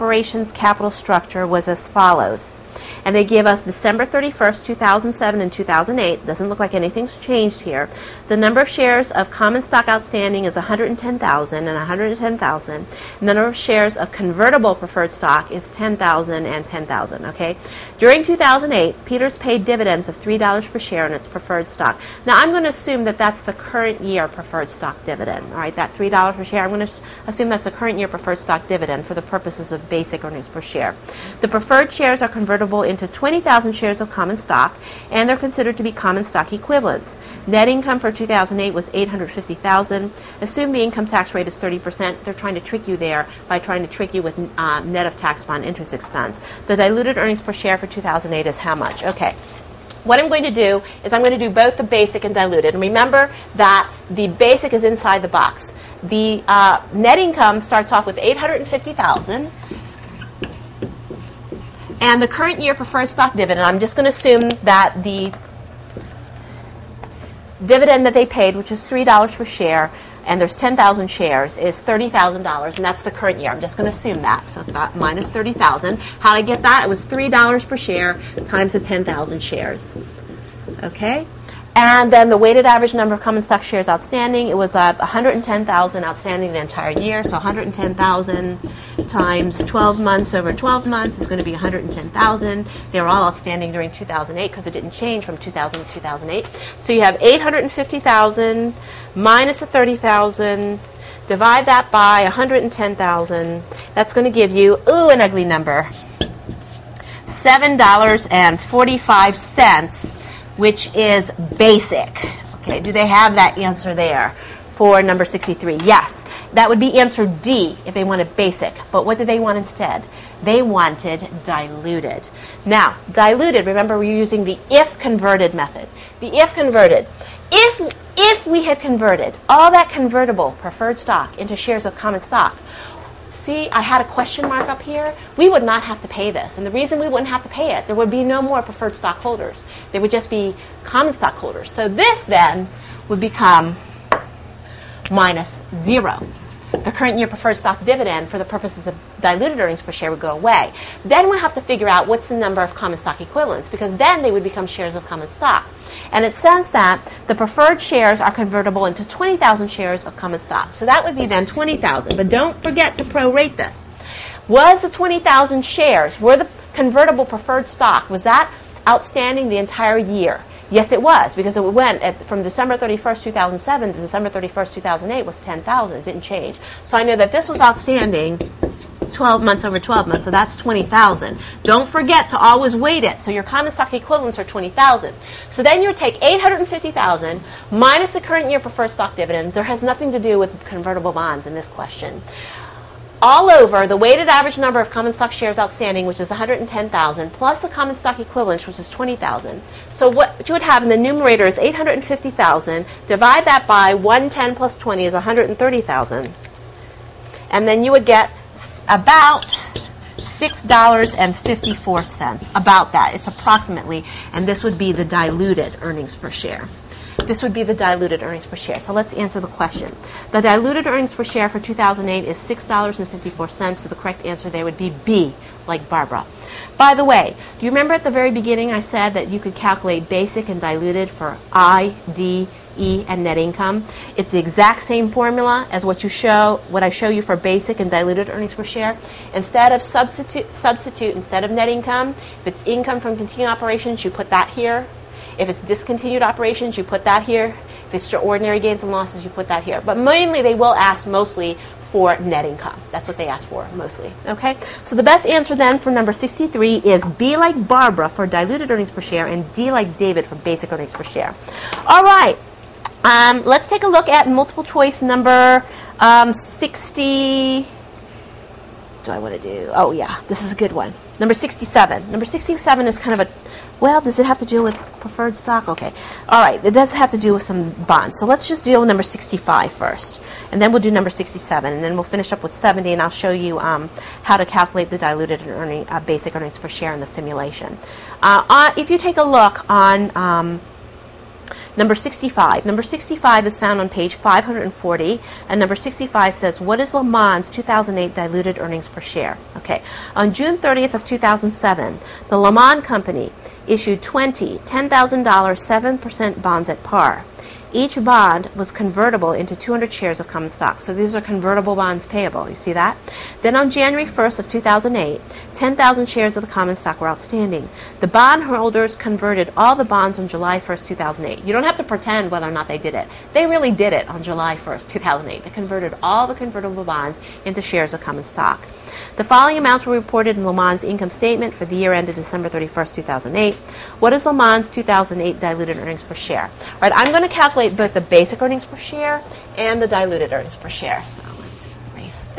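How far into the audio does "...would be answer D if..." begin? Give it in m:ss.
1:56.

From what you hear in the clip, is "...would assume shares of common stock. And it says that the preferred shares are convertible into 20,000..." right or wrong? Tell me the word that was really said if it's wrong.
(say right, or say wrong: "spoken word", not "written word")
wrong: "become", not "assume".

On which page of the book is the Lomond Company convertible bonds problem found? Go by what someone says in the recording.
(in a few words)
540.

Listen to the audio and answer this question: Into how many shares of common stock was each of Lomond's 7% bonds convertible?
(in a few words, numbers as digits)
200.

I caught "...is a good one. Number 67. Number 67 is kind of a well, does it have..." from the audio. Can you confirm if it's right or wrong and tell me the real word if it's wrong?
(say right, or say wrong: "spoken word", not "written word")
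right.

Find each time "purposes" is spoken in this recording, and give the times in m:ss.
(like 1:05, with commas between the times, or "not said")
0:29, 2:28.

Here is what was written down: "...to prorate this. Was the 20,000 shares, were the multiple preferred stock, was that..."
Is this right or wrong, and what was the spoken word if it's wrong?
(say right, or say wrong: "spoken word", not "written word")
wrong: "convertible", not "multiple".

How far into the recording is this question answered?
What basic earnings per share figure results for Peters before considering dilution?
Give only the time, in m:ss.
1:47.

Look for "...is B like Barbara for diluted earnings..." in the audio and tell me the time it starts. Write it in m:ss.
4:16.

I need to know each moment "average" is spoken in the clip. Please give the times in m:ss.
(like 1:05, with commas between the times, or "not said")
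1:22, 3:14.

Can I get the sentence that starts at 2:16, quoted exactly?
And the reason we wouldn't have to pay it, there would be no more preferred stockholders.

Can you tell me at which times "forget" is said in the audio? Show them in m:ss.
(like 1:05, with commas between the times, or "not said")
2:42, 3:01.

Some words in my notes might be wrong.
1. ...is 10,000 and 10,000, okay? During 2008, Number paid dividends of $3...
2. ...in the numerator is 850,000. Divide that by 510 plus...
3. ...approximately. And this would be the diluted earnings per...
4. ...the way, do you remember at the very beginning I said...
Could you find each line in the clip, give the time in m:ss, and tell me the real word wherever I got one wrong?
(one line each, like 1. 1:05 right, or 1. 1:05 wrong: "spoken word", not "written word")
1. 0:15 wrong: "Peters", not "Number"
2. 3:20 wrong: "110", not "510"
3. 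3:33 right
4. 3:46 right.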